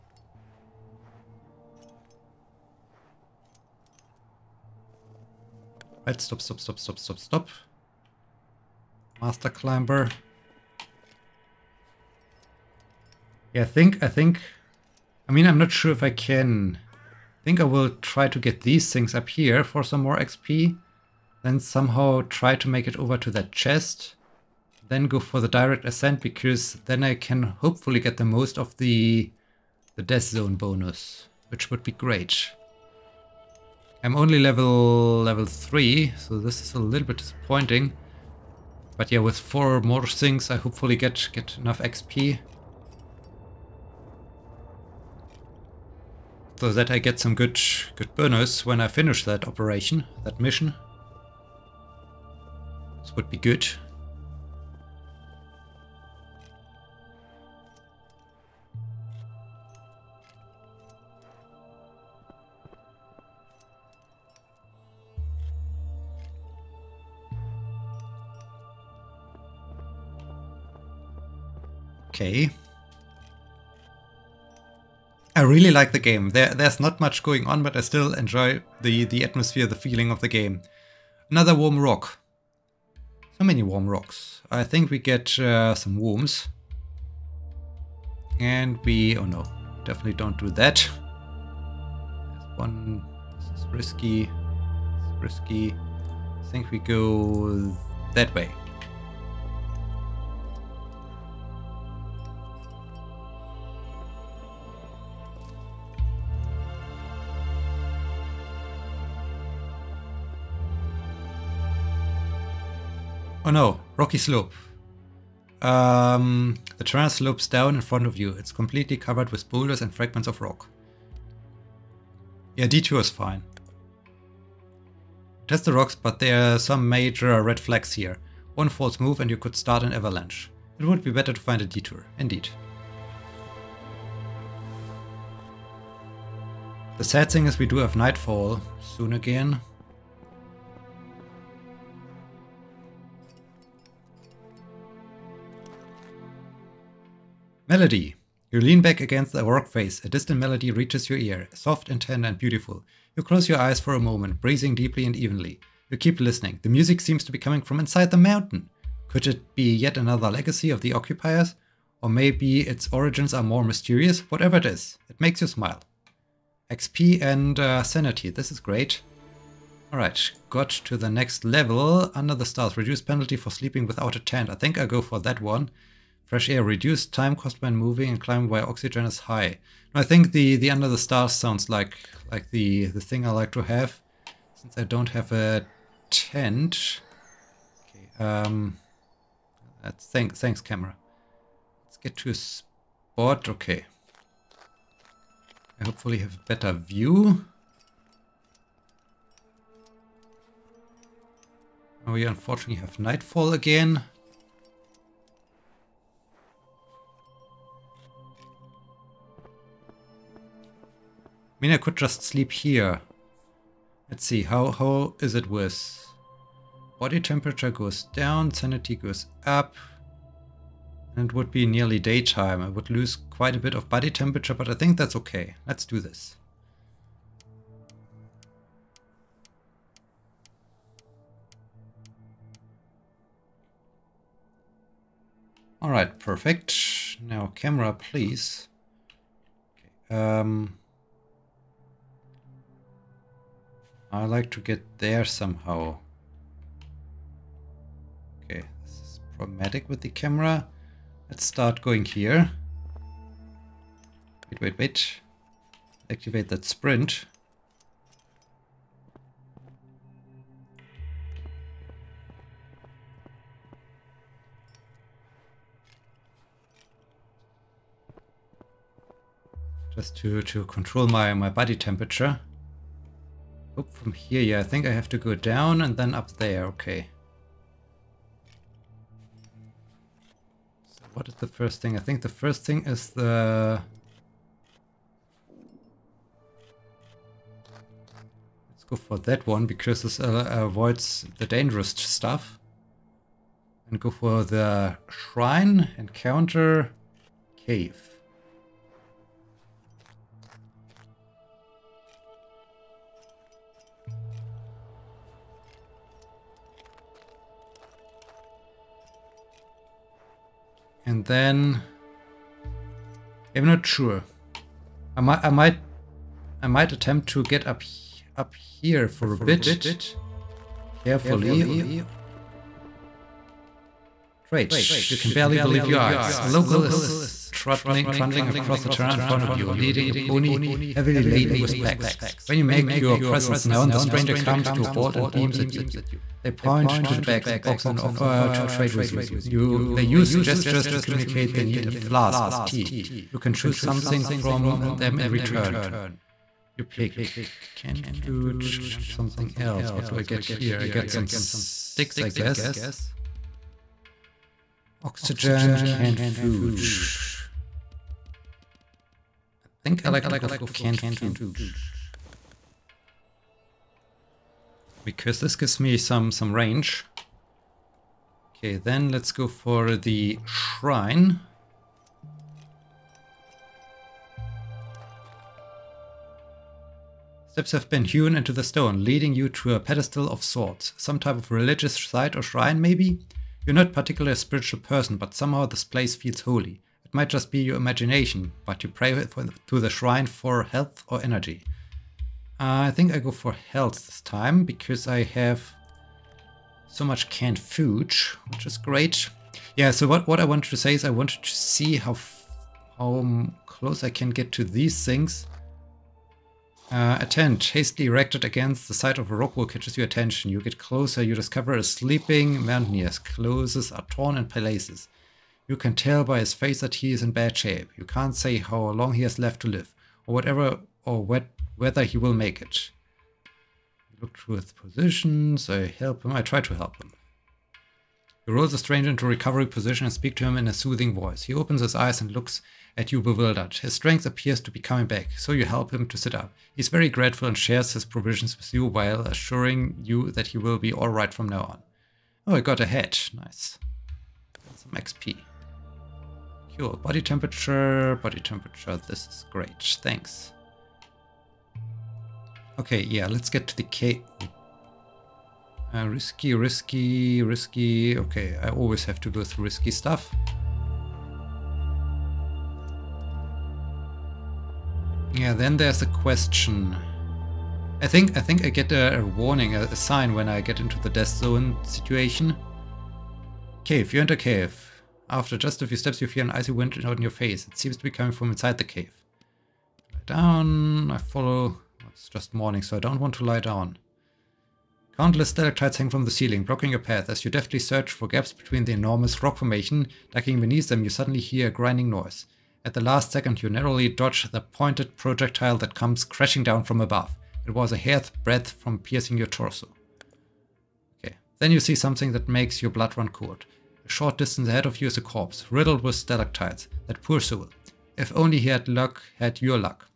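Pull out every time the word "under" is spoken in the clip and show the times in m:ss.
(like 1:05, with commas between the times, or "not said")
2:52, 3:00.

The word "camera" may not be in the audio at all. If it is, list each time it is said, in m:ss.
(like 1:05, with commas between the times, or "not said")
3:10, 3:57, 4:10.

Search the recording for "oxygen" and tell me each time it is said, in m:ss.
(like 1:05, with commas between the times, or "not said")
2:58, 5:55.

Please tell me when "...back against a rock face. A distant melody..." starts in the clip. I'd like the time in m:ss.
2:28.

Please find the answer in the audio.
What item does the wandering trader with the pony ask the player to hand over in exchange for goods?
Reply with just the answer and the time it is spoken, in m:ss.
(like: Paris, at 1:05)
a flask of tea, at 5:41.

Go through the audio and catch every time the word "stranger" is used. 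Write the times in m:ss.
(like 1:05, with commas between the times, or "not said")
5:33, 7:08.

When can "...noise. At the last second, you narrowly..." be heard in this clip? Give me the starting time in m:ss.
8:12.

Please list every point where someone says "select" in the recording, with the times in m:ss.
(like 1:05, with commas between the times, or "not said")
not said.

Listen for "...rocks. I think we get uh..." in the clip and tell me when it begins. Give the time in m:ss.
1:23.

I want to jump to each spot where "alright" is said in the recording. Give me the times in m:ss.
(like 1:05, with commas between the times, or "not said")
2:49, 3:55, 7:20.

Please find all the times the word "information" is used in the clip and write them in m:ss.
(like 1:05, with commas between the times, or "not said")
not said.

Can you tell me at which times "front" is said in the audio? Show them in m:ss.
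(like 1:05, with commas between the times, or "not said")
1:57, 5:29.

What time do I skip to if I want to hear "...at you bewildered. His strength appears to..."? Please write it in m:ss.
7:12.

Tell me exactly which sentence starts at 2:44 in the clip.
Whatever it is, it makes you smile.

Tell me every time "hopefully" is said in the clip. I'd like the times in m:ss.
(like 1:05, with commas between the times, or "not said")
0:27, 0:40, 3:15.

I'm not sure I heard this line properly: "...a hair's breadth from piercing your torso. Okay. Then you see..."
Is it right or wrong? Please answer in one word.
right.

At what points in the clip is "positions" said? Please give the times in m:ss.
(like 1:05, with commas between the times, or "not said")
7:04, 7:09.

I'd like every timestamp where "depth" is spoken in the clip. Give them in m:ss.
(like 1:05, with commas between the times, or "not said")
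not said.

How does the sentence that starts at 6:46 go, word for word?
Uh, tent Hastily erected against the side of a rock wall catches your attention.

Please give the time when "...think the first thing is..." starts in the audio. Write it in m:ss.
4:42.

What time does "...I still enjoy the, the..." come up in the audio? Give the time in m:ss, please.
1:17.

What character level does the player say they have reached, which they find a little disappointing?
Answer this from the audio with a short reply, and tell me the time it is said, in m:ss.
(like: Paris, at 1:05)
3, at 0:35.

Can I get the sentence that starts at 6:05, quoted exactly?
because this gives me some, some range.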